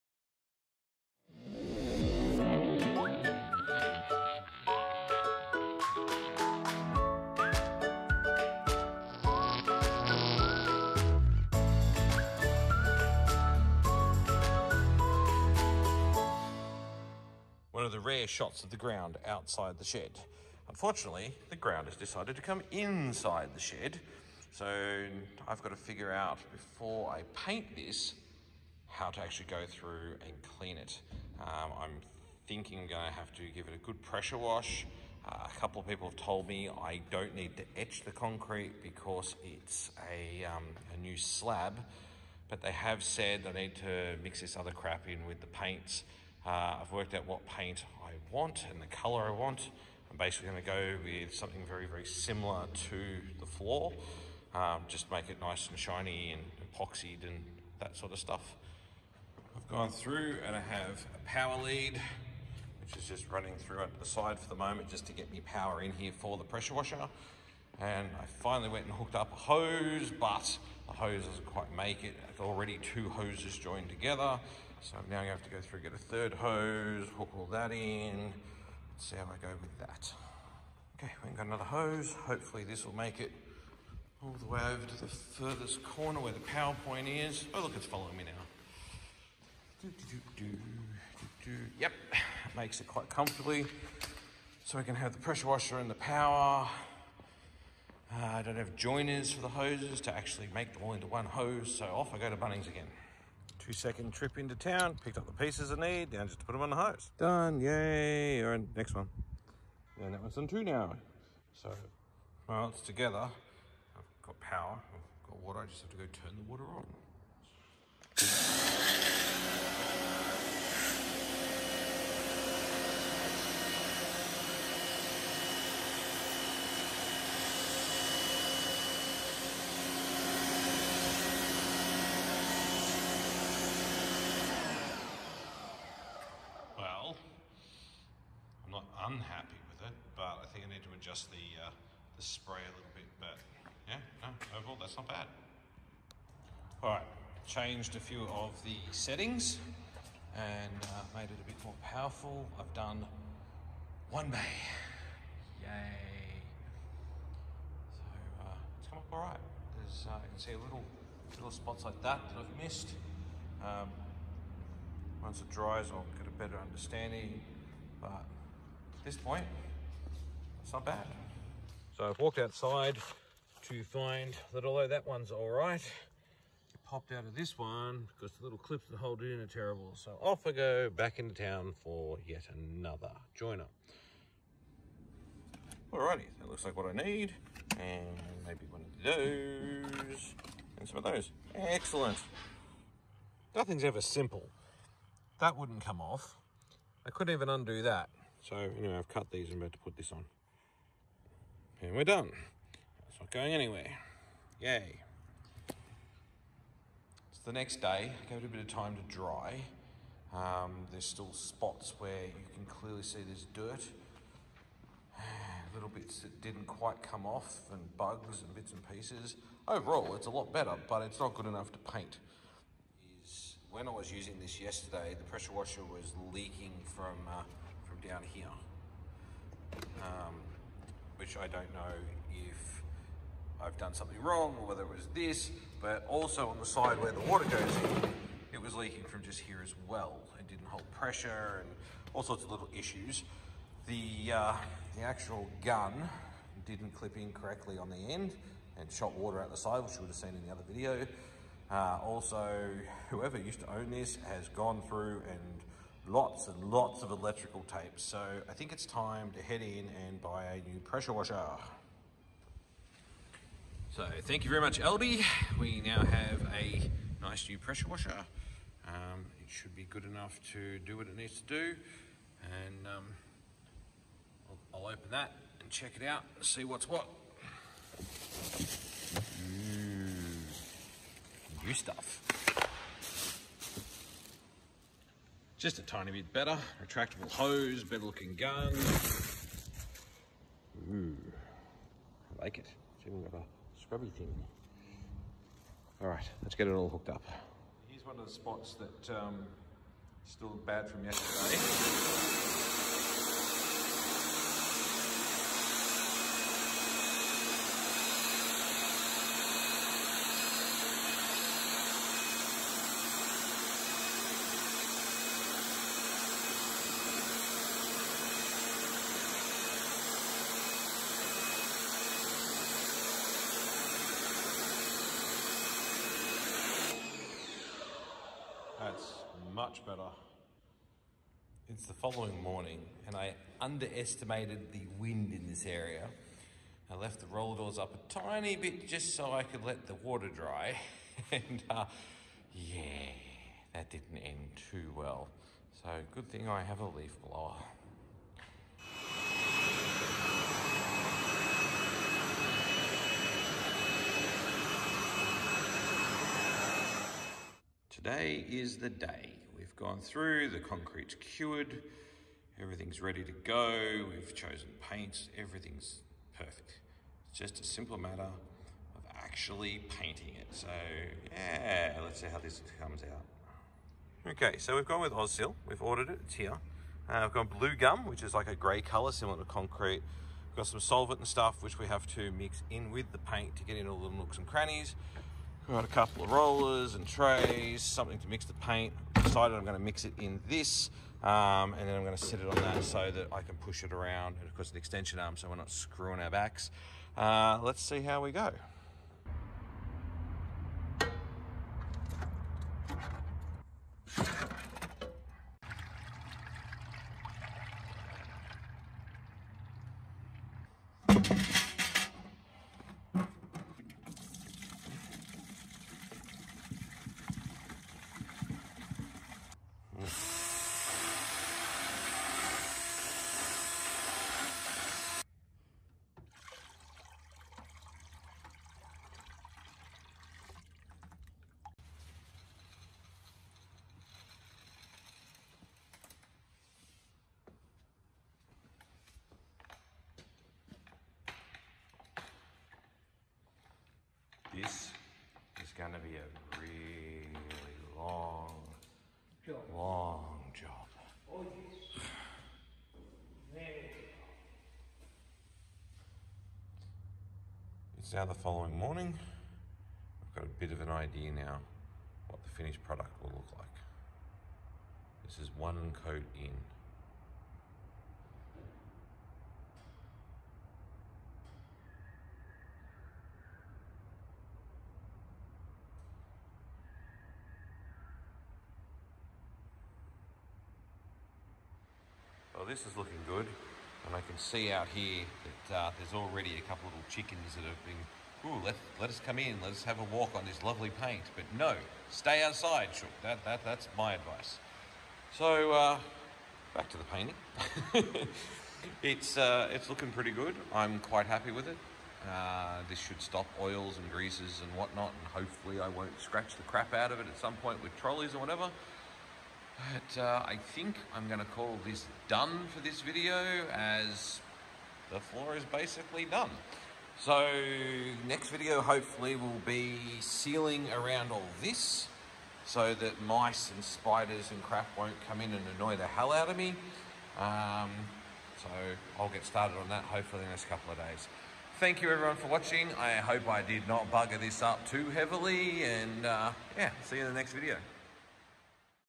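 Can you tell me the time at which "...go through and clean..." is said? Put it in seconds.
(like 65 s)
29 s.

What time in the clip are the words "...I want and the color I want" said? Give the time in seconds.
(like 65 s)
48 s.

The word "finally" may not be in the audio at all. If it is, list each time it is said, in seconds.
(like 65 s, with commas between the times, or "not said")
68 s.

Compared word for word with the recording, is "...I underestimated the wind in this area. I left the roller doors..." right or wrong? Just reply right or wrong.
right.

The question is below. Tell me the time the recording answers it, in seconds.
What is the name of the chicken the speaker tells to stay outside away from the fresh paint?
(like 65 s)
492 s.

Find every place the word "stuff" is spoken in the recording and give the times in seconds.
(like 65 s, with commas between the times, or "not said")
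58 s, 281 s, 381 s.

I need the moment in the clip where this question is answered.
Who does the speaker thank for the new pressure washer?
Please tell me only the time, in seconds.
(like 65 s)
264 s.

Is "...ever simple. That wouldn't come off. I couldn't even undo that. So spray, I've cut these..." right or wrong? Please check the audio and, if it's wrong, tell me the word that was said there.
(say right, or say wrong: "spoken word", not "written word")
wrong: "anyway", not "spray".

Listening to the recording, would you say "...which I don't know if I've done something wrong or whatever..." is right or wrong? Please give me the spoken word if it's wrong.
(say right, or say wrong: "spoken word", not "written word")
wrong: "whether", not "whatever".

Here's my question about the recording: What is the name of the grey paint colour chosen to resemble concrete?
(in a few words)
Blue gum.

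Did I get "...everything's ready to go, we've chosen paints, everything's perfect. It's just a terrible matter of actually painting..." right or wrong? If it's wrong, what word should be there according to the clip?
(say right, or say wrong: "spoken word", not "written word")
wrong: "simple", not "terrible".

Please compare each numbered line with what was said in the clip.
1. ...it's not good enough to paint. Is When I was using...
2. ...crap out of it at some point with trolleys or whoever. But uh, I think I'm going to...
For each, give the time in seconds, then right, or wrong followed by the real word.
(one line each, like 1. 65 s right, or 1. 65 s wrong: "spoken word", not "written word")
1. 221 s right
2. 506 s wrong: "whatever", not "whoever".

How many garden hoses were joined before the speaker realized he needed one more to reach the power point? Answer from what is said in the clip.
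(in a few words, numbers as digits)
2.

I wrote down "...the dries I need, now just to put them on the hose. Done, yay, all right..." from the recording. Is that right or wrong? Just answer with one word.
wrong.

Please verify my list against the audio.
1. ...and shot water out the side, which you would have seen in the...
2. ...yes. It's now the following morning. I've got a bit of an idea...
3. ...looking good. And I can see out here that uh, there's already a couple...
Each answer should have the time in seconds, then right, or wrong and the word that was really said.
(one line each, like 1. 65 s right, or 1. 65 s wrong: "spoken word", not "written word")
1. 248 s right
2. 451 s right
3. 482 s right.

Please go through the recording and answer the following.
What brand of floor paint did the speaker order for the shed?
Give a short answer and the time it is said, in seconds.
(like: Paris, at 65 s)
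Ozil, at 375 s.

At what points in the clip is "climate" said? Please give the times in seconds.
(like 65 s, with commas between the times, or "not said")
not said.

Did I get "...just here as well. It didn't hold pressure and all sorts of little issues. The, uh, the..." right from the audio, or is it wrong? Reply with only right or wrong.
right.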